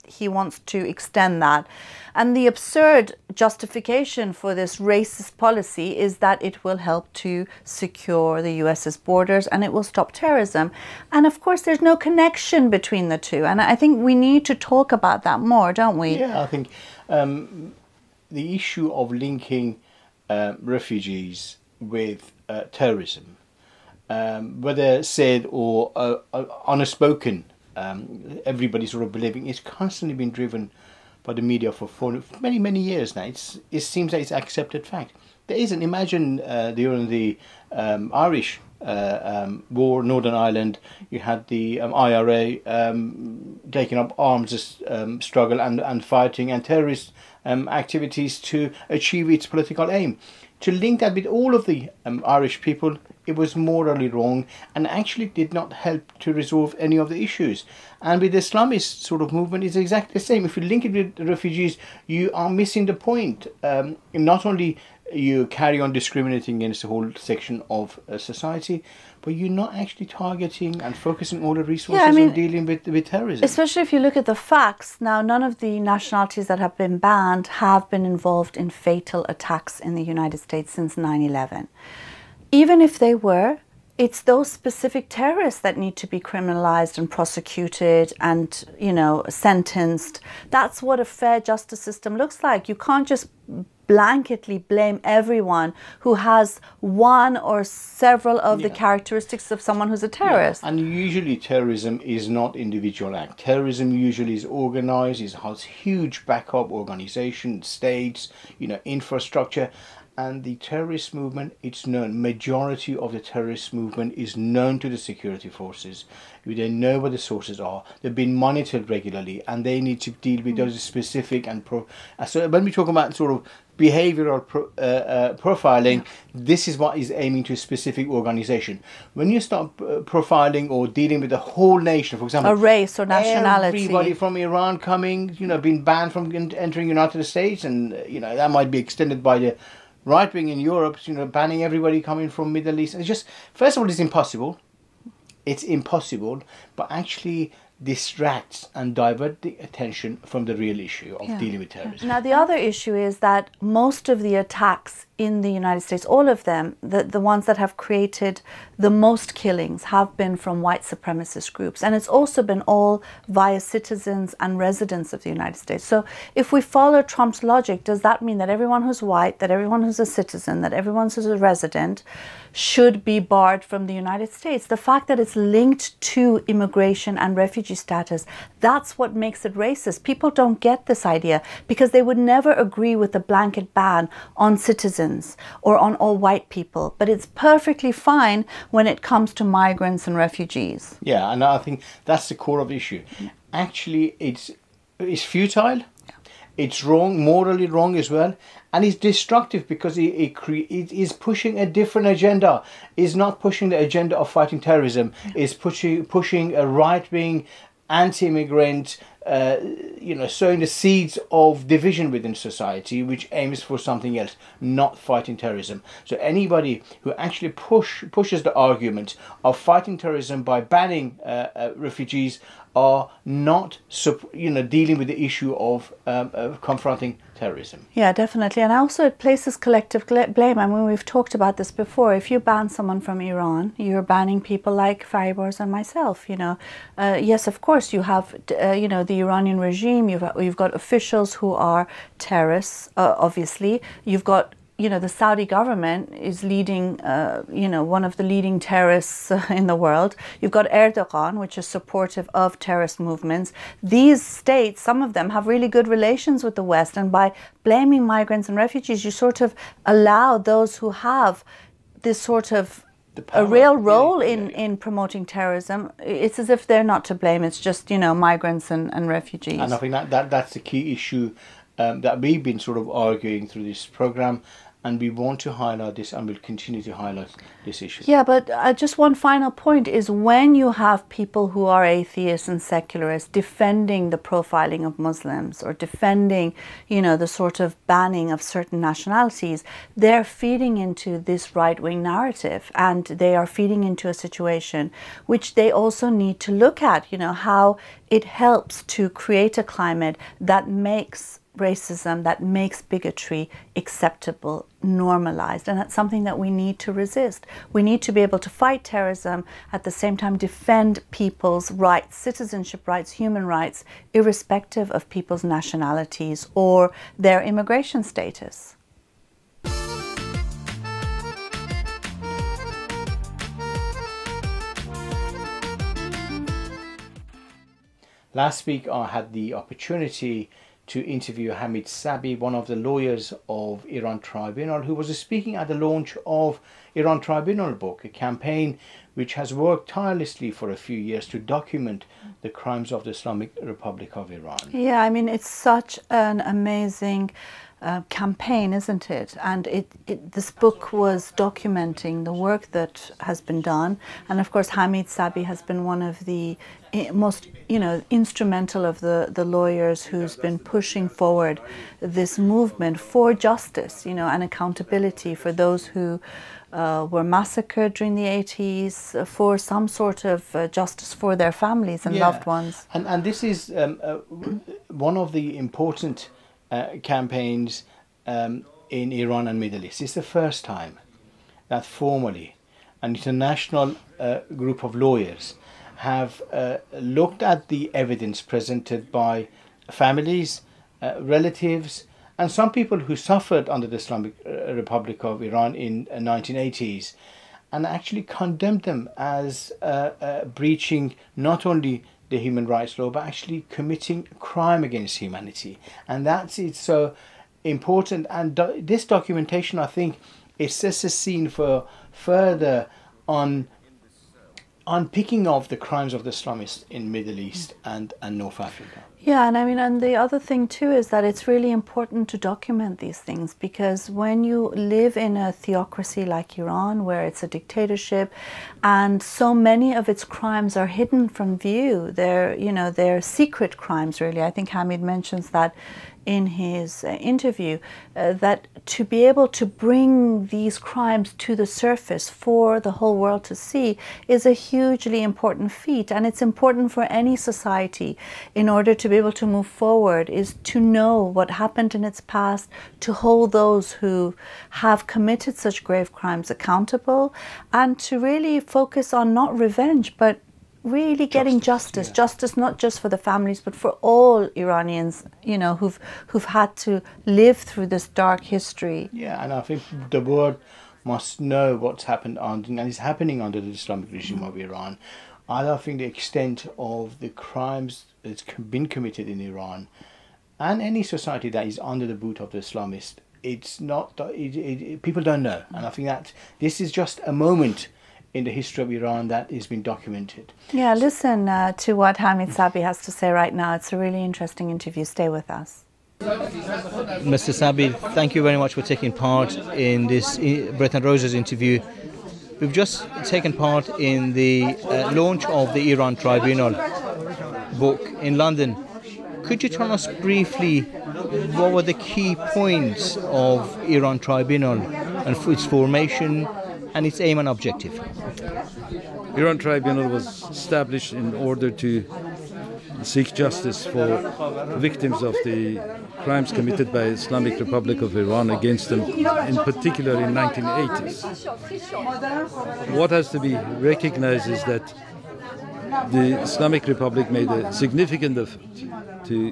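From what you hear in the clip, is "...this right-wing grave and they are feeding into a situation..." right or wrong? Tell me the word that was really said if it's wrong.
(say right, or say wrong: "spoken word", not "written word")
wrong: "narrative", not "grave".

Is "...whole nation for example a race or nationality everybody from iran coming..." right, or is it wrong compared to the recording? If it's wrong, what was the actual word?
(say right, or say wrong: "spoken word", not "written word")
right.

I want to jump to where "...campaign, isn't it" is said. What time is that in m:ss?
5:48.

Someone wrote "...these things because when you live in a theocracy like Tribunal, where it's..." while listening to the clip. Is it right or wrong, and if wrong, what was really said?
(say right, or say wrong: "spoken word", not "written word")
wrong: "Iran", not "Tribunal".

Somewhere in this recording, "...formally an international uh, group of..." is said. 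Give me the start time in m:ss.
6:21.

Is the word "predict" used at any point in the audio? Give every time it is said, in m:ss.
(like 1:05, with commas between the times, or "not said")
not said.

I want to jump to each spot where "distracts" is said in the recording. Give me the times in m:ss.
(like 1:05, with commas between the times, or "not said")
2:27.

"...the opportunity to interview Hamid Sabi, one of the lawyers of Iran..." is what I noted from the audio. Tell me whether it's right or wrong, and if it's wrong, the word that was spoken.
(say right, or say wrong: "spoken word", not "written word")
right.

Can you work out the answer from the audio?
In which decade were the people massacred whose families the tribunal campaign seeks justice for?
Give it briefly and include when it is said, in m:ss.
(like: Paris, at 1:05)
the 80s, at 6:08.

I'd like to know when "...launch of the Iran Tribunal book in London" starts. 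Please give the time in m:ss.
8:25.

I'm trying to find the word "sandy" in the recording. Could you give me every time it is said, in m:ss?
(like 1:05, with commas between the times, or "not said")
not said.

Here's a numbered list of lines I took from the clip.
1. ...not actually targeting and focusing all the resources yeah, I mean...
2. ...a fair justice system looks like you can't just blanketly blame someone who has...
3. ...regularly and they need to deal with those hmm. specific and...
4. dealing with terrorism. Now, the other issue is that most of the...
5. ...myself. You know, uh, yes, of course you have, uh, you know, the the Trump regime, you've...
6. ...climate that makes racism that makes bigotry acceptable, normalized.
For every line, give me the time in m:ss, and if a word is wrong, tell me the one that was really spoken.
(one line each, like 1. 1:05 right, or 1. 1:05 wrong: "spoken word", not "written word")
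1. 1:09 right
2. 1:30 wrong: "everyone", not "someone"
3. 1:58 right
4. 2:31 right
5. 3:55 wrong: "Iranian", not "Trump"
6. 4:59 right.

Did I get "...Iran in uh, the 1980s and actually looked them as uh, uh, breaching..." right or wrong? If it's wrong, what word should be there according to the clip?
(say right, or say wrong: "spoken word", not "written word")
wrong: "condemned", not "looked".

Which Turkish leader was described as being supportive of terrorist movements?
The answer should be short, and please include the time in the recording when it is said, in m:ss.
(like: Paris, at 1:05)
Erdogan, at 4:10.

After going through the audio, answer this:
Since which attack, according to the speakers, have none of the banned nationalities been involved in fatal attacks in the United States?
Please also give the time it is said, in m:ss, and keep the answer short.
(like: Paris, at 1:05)
9/11, at 1:20.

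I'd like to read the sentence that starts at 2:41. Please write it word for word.
And it's also been all via citizens and residents of the United States.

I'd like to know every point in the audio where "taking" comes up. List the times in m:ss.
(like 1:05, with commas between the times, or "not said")
0:43, 8:18.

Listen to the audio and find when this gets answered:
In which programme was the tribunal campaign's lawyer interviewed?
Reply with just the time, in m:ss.
8:20.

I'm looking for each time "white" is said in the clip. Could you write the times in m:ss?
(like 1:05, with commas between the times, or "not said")
2:40, 2:49, 3:06.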